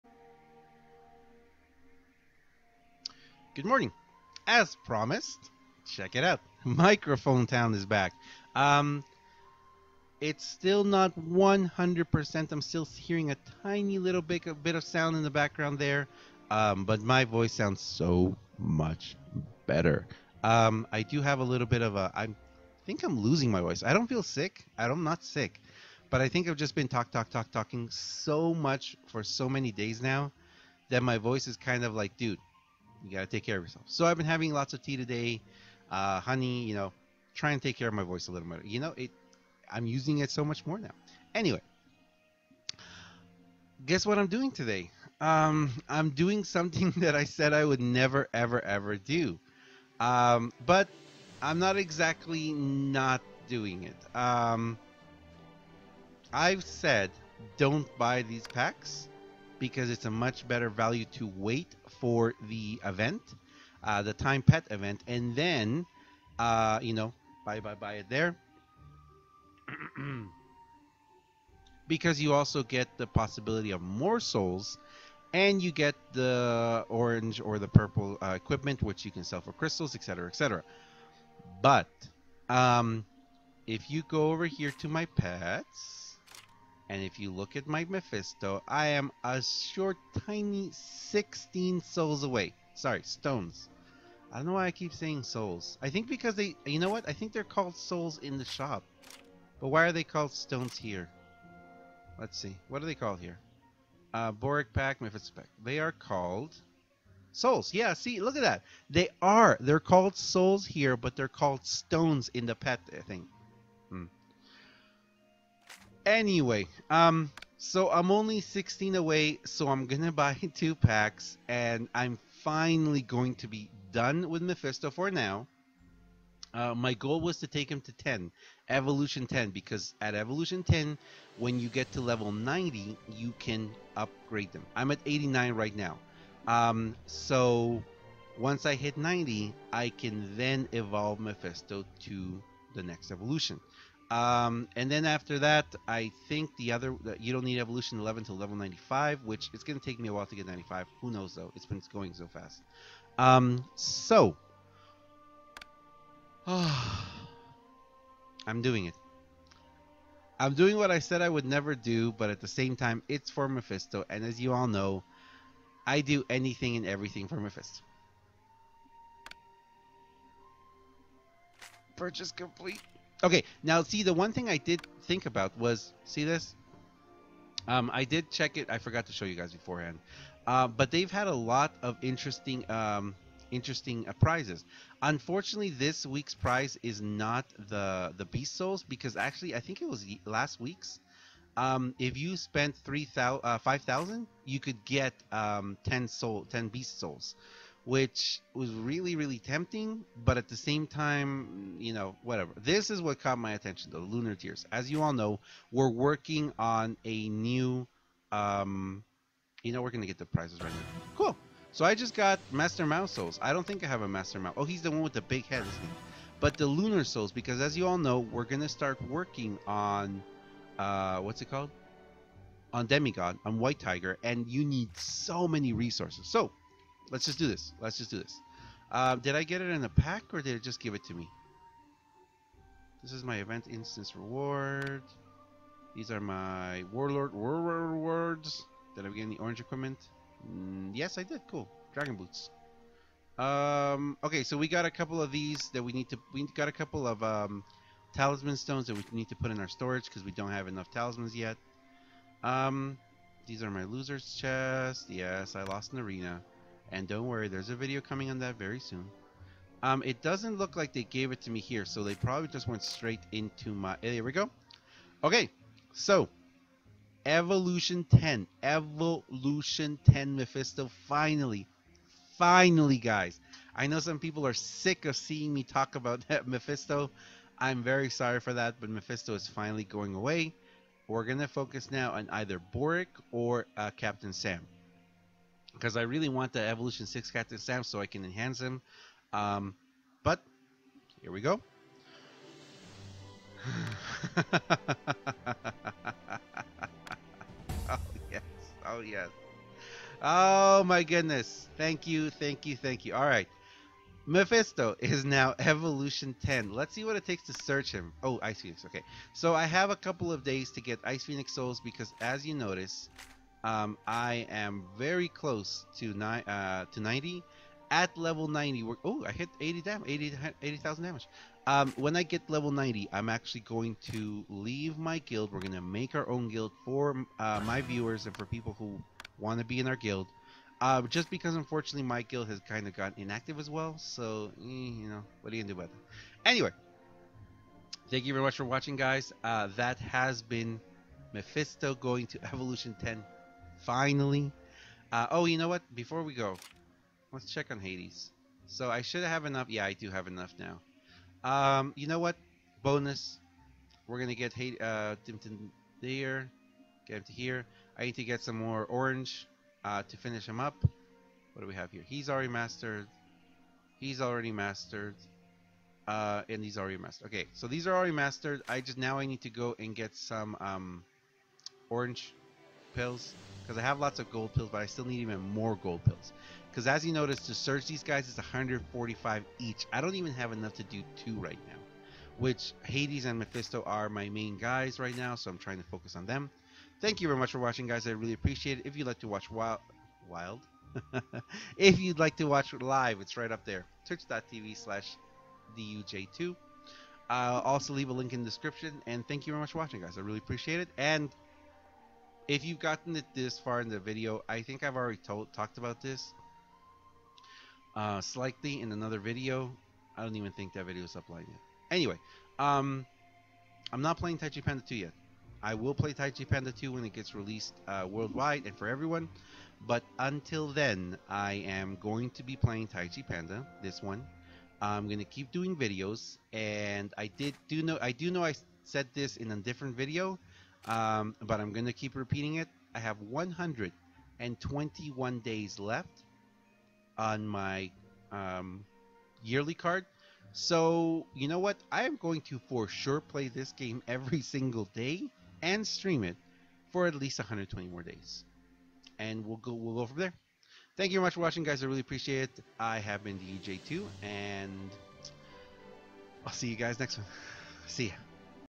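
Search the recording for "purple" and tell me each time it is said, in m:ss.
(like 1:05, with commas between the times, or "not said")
1:17.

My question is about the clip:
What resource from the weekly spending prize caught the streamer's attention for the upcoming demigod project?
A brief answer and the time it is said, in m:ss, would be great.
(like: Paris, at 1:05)
Lunar tears, at 3:23.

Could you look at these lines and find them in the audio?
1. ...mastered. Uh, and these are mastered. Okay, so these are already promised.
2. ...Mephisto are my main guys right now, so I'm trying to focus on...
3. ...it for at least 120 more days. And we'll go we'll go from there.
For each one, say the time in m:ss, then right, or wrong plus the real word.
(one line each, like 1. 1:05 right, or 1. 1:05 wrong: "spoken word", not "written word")
1. 6:04 wrong: "mastered", not "promised"
2. 6:23 right
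3. 7:26 right.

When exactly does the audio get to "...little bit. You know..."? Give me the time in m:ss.
0:38.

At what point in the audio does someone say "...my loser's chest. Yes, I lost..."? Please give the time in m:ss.
4:13.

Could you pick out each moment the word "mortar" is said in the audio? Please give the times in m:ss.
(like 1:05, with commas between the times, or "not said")
not said.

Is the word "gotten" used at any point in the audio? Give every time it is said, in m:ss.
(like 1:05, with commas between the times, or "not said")
5:32, 6:42.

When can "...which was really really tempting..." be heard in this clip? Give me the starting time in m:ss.
3:17.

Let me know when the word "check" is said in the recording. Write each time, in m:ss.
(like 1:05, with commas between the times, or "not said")
0:05, 2:58, 5:47.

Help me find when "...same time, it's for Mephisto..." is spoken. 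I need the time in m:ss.
2:42.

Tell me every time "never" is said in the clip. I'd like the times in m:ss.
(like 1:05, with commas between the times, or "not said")
0:47, 2:41.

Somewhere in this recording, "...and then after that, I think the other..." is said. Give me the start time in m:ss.
2:24.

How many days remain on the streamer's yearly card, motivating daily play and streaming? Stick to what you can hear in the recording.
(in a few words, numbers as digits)
121.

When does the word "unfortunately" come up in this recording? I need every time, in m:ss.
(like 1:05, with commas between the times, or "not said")
3:05, 5:31.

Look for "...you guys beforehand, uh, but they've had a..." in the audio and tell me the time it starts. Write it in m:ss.
2:59.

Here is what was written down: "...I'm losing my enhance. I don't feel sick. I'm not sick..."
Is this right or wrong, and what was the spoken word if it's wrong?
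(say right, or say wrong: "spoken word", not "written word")
wrong: "voice", not "enhance".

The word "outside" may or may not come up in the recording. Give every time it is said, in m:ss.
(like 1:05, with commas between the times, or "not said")
not said.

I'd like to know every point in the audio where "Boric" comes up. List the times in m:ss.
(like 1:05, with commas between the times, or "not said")
1:44, 4:42.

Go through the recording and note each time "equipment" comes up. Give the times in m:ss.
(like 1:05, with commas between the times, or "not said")
1:18, 3:59.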